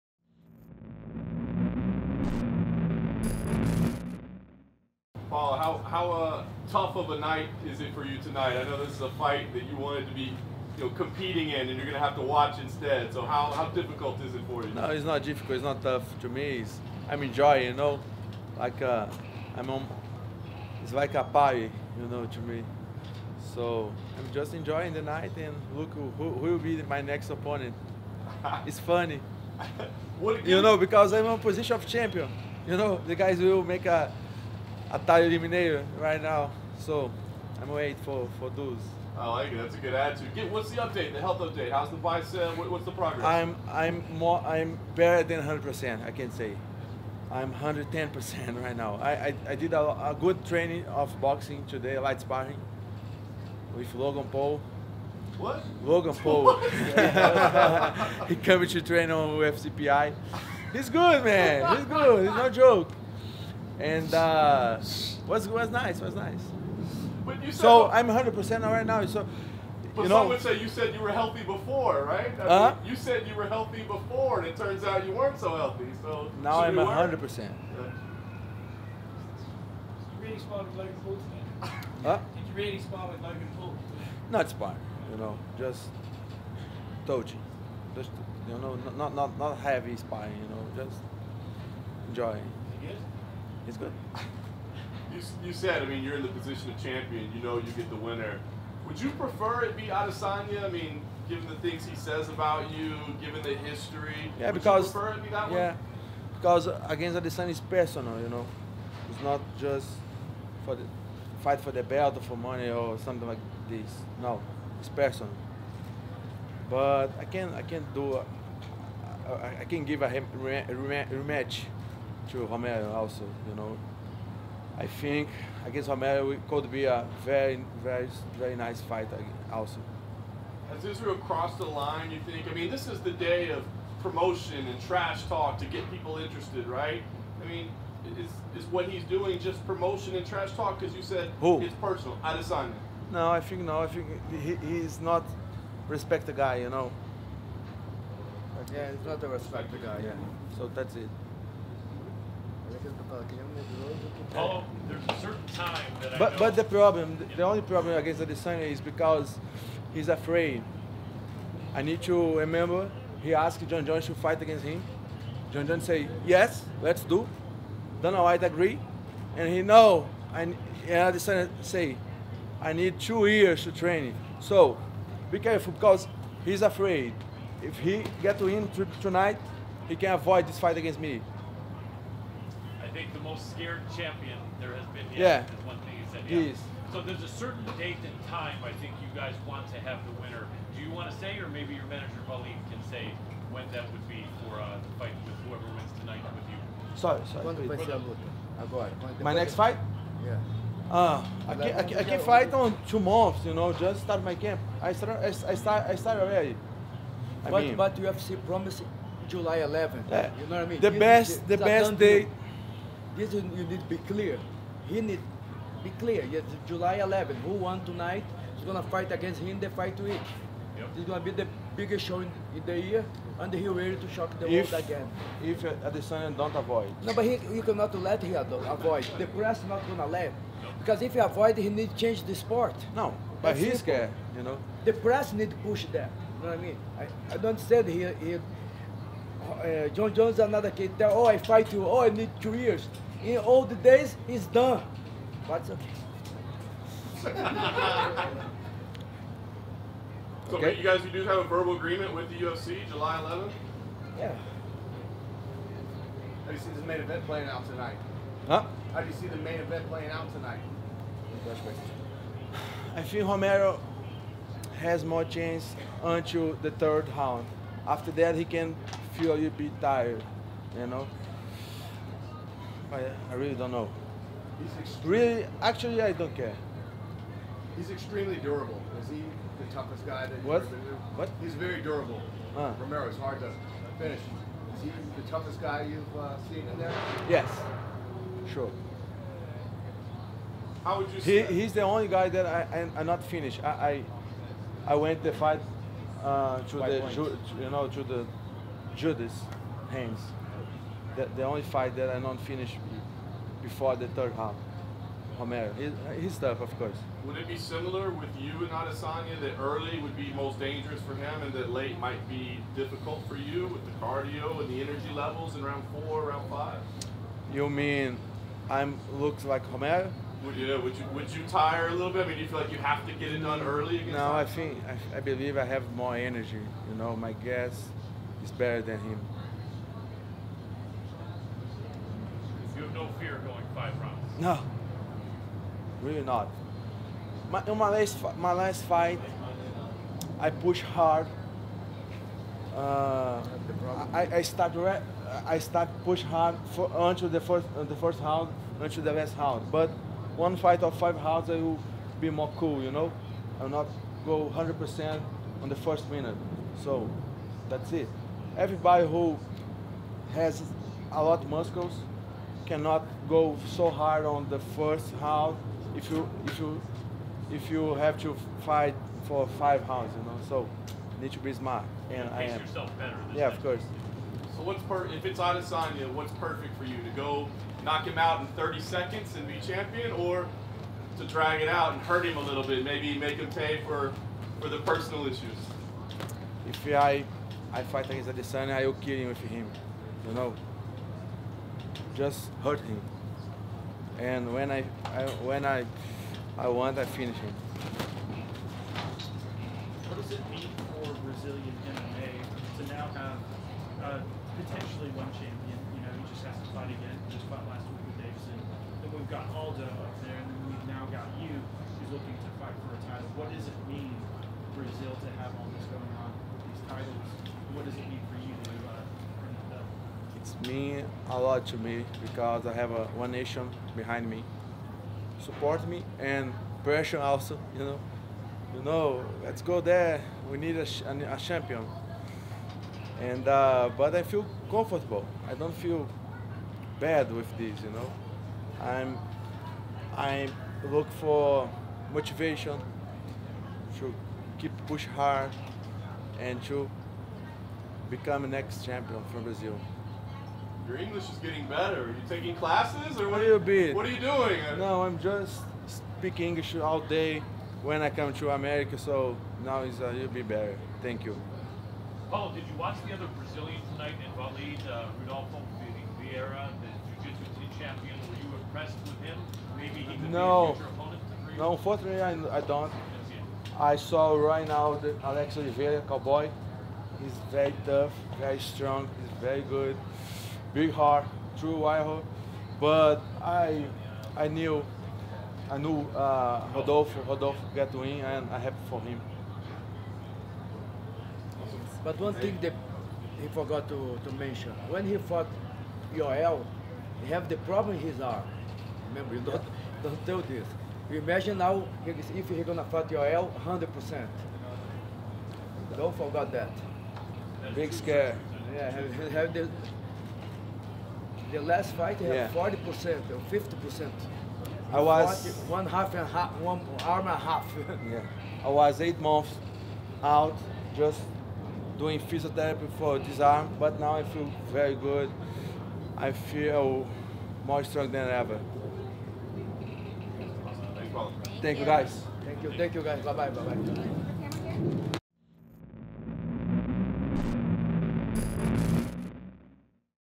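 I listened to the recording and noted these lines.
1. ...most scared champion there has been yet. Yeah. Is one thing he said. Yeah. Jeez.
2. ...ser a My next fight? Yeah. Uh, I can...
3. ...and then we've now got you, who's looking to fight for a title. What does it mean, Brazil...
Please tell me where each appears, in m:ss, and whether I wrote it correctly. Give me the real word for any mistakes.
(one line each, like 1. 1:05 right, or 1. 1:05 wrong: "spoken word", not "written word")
1. 3:03 right
2. 3:17 right
3. 6:50 right.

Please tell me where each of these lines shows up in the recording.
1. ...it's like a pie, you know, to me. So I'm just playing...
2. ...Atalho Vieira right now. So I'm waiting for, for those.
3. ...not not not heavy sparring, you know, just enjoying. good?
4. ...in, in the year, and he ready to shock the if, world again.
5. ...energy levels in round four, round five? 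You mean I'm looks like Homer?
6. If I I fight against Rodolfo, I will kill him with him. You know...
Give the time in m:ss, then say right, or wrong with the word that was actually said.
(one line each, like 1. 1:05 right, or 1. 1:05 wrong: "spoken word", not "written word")
1. 0:20 wrong: "enjoying", not "playing"
2. 0:34 wrong: "Mineiro", not "Vieira"
3. 1:28 right
4. 3:42 right
5. 5:14 right
6. 6:26 wrong: "Adesanya", not "Rodolfo".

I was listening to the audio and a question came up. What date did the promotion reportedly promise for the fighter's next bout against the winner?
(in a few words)
July 11.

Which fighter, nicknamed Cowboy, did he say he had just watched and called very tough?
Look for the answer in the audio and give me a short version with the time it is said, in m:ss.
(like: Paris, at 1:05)
Alex Oliveira, at 7:55.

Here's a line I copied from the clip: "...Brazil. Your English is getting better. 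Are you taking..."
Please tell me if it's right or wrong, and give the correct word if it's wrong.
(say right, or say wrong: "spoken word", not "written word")
right.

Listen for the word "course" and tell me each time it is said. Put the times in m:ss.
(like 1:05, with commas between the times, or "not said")
5:06, 6:13.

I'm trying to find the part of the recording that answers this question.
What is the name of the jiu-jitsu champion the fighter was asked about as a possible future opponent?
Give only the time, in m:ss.
7:45.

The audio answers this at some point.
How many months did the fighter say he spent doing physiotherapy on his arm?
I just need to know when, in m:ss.
8:38.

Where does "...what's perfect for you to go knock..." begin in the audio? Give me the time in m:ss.
6:16.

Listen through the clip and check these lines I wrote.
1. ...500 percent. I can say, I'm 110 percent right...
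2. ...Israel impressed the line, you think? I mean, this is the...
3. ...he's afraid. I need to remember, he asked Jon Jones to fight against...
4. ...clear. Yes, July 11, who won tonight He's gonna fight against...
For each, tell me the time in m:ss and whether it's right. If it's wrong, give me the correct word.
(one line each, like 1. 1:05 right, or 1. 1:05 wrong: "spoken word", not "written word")
1. 0:45 wrong: "100", not "500"
2. 2:10 wrong: "crossed", not "impressed"
3. 2:39 right
4. 3:35 right.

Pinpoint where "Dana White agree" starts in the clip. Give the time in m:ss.
2:48.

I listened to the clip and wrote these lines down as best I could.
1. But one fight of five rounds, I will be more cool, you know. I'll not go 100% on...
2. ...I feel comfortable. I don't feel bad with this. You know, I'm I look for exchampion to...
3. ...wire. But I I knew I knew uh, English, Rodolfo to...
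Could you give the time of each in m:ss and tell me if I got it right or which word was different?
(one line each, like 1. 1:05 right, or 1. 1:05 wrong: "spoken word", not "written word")
1. 5:49 right
2. 7:14 wrong: "motivation", not "exchampion"
3. 8:01 wrong: "Rodolfo", not "English".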